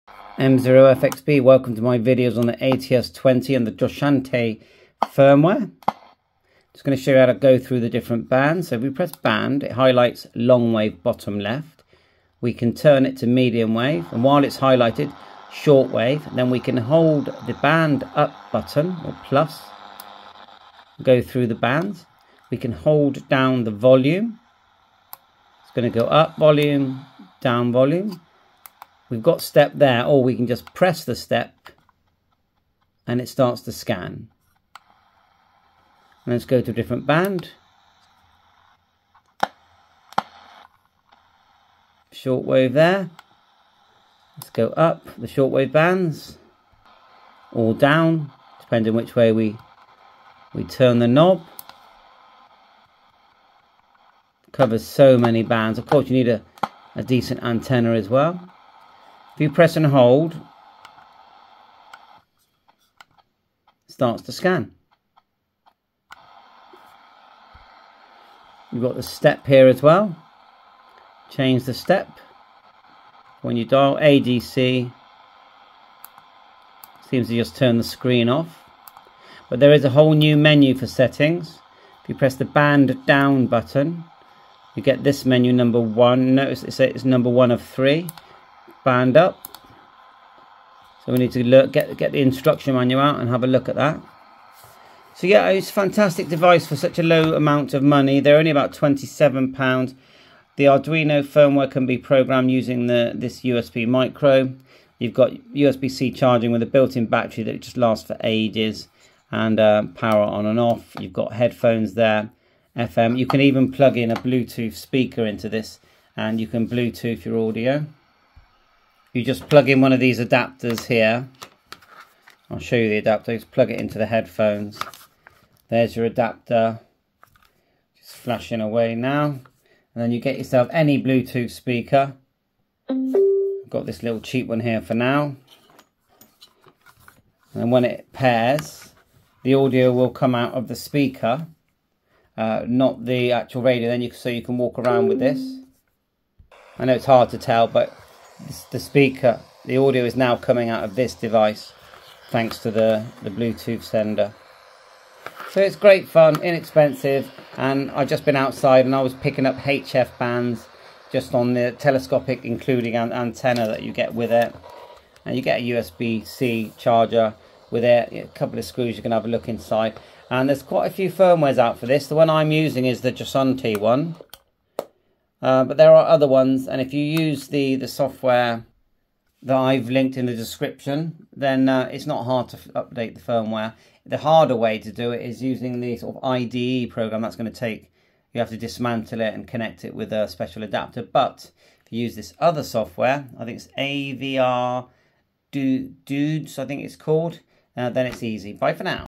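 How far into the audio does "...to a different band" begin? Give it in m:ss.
0:36.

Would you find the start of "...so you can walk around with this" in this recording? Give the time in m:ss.
2:24.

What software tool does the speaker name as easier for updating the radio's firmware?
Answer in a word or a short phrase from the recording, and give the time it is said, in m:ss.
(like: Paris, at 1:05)
AVR Dudes, at 3:13.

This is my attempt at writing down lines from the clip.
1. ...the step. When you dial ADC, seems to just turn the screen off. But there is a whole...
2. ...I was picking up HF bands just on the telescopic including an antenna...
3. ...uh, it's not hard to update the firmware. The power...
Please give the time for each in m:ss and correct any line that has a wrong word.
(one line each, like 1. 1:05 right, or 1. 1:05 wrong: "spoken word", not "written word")
1. 1:11 right
2. 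2:38 right
3. 3:01 wrong: "harder", not "power".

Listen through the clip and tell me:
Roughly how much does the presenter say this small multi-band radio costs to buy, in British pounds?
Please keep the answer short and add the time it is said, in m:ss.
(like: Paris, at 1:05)
£27, at 1:38.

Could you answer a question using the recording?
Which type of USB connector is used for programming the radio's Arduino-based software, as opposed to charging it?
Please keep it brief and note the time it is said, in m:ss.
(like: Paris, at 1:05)
USB micro, at 1:43.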